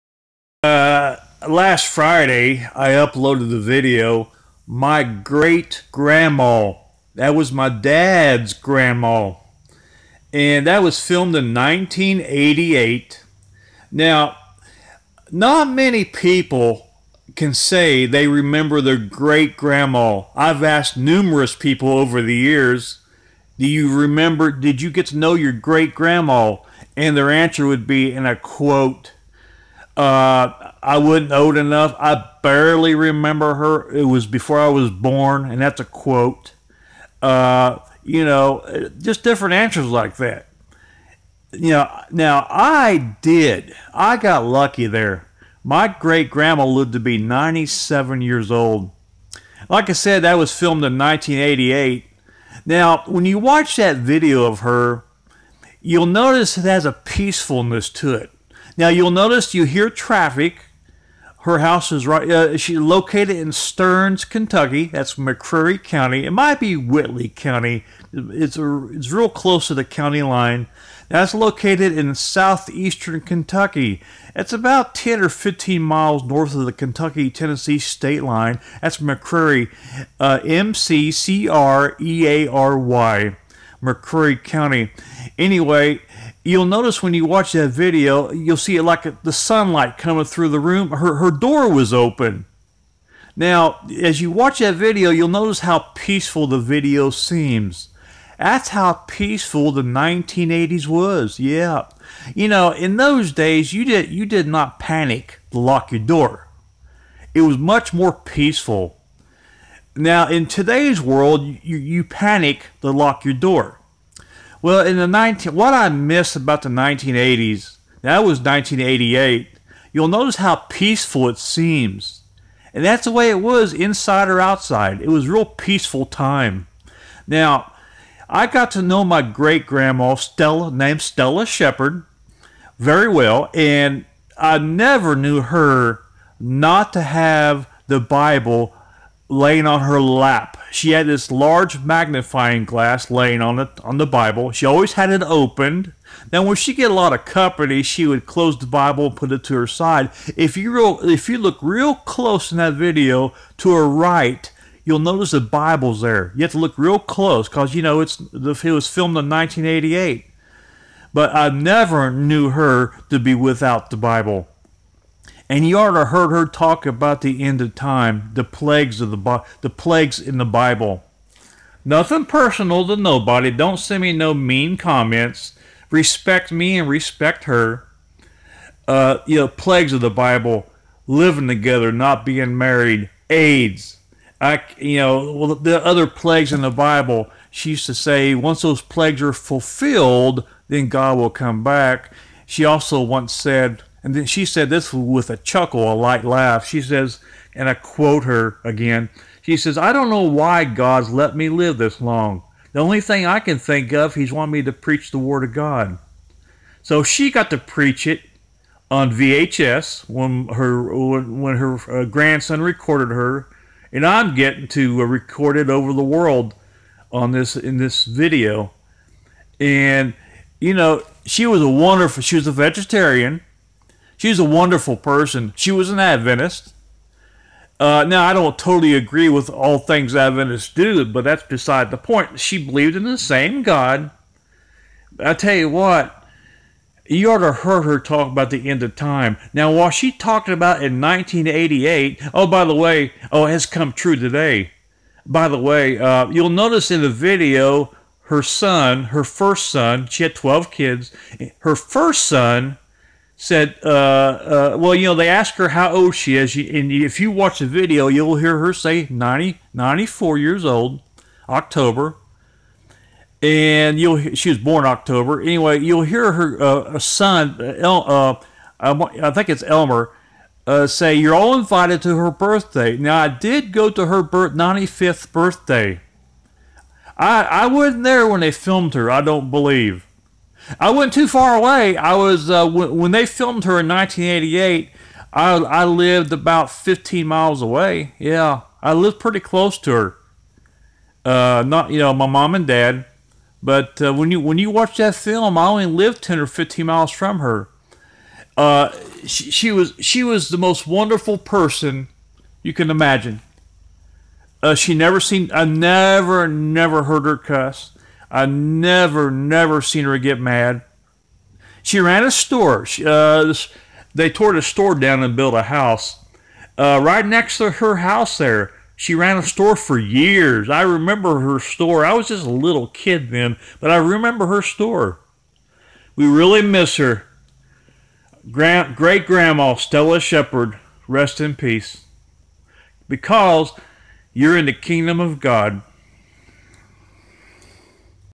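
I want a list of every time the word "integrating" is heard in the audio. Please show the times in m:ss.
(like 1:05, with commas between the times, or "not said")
not said.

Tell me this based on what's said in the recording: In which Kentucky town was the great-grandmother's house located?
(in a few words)
Stearns.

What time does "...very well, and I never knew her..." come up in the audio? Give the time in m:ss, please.
2:12.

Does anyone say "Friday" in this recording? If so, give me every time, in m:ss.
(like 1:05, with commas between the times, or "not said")
0:01.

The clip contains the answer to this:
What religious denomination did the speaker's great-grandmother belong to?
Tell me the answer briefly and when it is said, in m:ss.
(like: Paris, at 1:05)
Adventist, at 3:45.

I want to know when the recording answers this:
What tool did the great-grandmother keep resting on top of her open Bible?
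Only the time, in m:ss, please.
2:21.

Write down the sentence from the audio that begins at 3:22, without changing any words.
The only thing I can think of, he's wanted me to preach the Word of God.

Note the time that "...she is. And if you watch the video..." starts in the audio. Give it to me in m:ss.
4:16.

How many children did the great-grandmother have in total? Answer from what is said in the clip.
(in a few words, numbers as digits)
12.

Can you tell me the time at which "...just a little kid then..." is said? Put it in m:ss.
5:22.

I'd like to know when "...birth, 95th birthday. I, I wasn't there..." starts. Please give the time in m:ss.
4:34.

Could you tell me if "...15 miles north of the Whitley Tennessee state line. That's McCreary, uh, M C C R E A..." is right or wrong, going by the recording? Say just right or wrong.
wrong.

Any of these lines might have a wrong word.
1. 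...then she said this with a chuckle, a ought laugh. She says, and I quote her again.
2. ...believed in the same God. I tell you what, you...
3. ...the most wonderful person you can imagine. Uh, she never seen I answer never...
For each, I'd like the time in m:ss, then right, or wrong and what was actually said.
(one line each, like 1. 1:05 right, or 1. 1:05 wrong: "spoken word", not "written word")
1. 3:14 wrong: "light", not "ought"
2. 3:52 right
3. 5:00 wrong: "never", not "answer".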